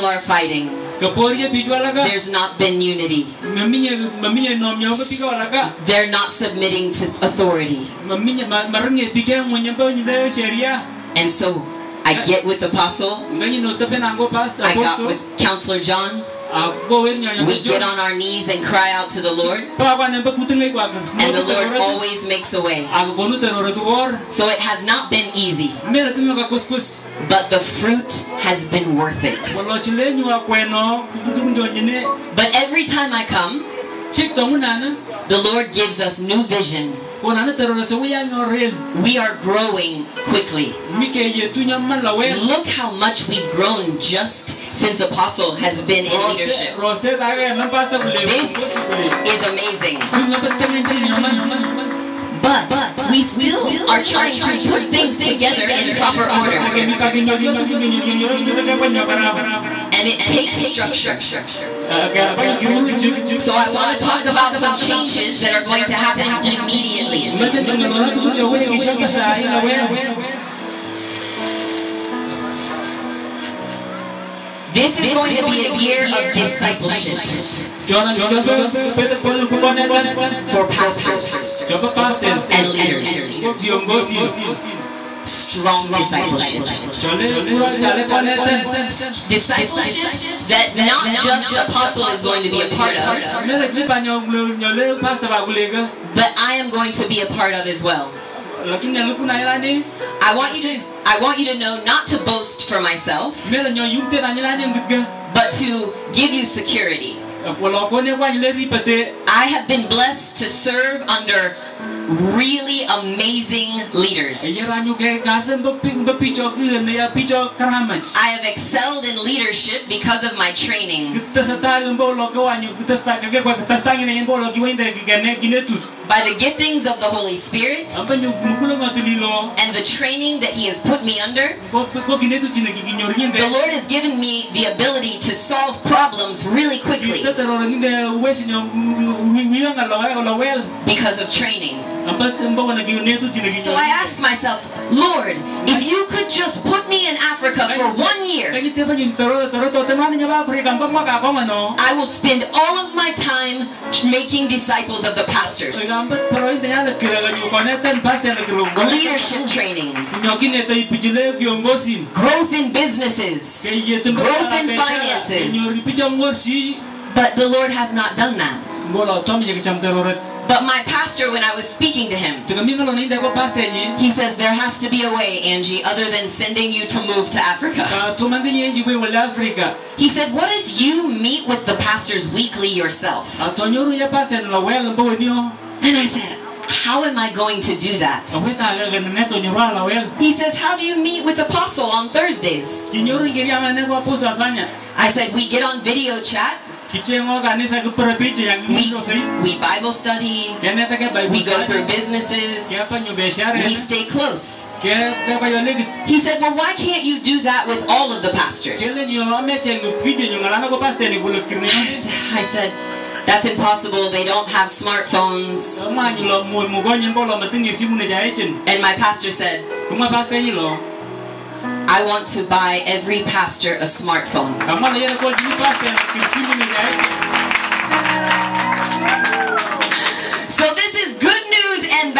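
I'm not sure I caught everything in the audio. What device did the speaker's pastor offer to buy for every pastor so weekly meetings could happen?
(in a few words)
Smartphone.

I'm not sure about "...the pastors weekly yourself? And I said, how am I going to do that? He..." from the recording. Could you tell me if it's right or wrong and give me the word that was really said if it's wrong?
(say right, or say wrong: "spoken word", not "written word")
right.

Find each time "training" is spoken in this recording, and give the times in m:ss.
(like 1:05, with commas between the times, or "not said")
2:00, 2:09, 2:21, 2:39.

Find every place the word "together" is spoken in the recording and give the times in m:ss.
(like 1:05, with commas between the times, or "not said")
0:55.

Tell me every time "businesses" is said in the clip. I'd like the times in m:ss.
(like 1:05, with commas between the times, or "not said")
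2:42, 3:21.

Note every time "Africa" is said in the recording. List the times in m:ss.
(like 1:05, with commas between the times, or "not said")
2:27, 2:57.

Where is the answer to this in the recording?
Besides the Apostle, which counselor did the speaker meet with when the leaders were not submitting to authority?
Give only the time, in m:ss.
0:15.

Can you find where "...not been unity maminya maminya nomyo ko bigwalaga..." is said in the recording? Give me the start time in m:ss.
0:02.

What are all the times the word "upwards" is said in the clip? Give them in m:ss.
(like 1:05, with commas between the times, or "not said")
not said.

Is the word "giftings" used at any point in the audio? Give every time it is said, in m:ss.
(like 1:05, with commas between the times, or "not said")
2:06.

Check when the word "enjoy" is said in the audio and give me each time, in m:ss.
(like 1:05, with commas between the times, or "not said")
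not said.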